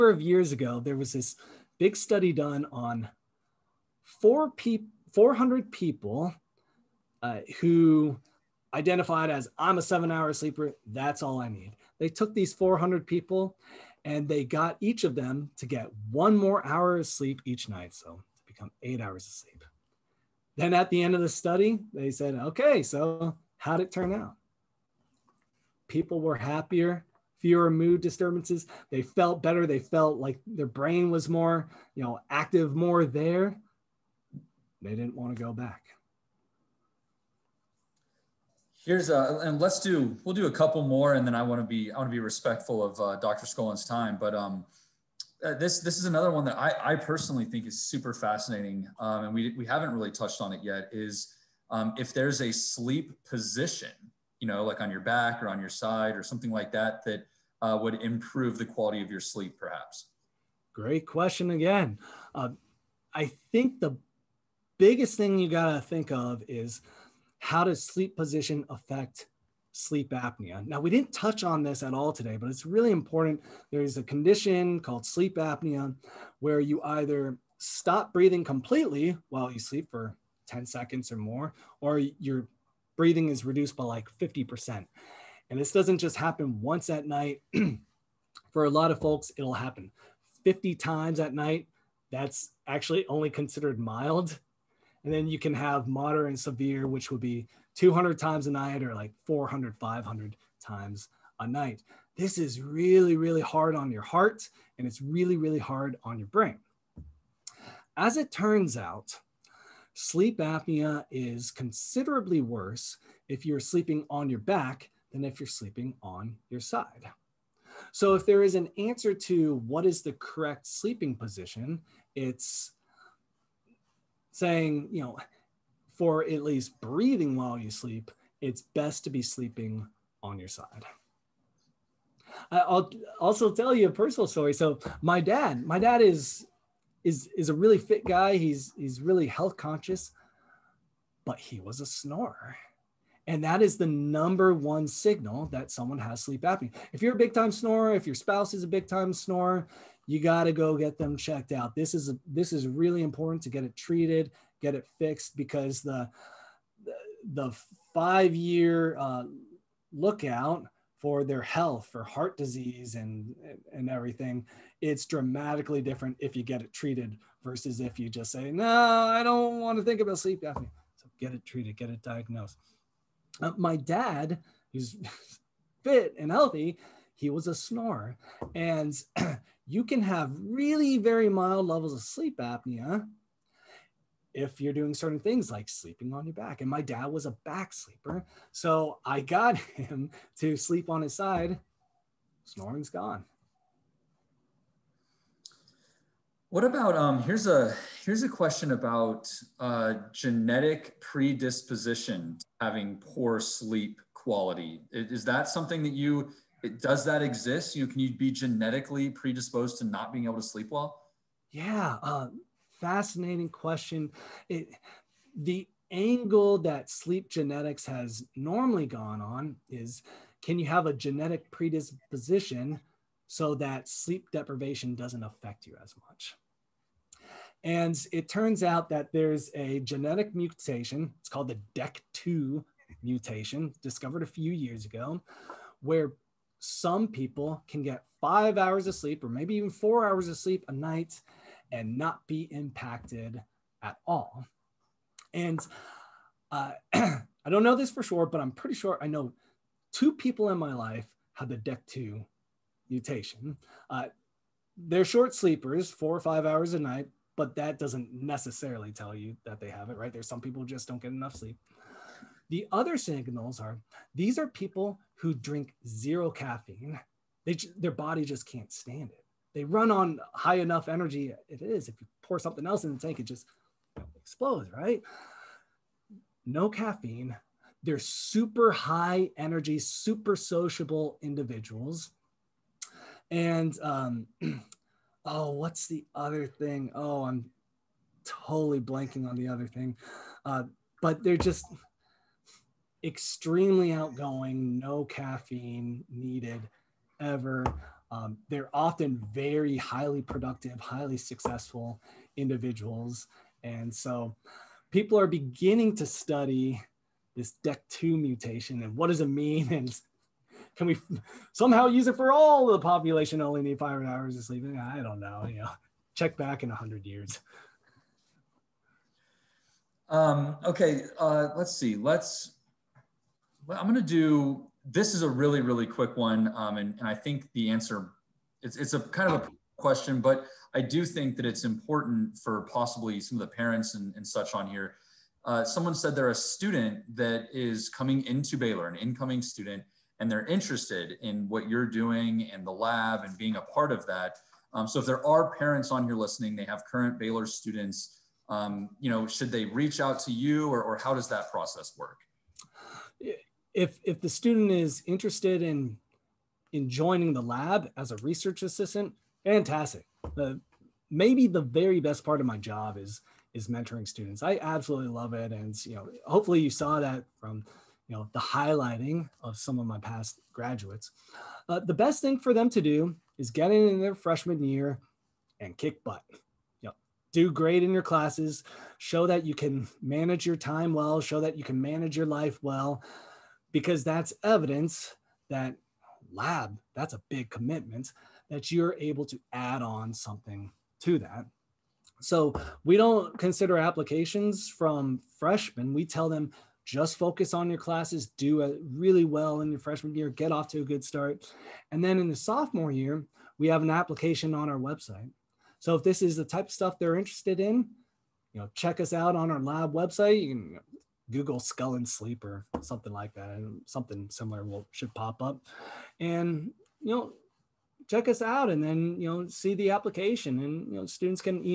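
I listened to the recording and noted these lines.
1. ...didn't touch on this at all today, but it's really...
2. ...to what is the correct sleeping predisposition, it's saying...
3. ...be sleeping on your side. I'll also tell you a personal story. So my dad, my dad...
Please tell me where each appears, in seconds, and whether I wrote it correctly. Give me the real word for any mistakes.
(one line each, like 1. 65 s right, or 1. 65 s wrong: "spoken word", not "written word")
1. 70 s right
2. 119 s wrong: "position", not "predisposition"
3. 129 s right.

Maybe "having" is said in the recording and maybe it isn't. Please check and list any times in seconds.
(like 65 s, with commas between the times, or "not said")
202 s.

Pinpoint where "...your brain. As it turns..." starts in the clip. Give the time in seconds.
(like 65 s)
106 s.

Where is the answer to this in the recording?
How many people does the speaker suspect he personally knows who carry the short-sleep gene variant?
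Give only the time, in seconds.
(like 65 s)
249 s.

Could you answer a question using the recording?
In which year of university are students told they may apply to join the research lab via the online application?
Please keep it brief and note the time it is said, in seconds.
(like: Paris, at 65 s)
Sophomore year, at 402 s.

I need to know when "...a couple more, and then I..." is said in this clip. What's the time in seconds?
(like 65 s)
40 s.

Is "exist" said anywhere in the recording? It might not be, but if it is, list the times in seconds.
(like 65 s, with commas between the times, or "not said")
207 s.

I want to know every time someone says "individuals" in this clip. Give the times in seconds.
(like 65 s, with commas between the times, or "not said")
281 s, 302 s.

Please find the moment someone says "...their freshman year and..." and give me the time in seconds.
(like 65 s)
374 s.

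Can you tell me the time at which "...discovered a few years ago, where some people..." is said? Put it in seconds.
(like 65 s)
233 s.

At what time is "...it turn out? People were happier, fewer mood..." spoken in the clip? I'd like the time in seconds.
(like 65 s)
23 s.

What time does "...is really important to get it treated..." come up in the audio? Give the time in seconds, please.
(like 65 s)
152 s.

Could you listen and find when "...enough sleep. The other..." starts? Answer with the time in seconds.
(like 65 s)
261 s.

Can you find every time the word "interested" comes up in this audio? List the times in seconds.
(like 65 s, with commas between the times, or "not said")
340 s, 355 s, 407 s.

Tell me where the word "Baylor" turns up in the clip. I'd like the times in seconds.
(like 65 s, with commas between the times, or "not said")
338 s, 347 s.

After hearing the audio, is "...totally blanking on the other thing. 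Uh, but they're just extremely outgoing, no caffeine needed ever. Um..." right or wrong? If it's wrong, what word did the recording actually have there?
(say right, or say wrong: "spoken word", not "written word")
right.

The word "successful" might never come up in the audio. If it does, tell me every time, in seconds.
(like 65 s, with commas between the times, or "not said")
301 s.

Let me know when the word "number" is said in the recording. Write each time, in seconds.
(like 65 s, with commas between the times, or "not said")
143 s.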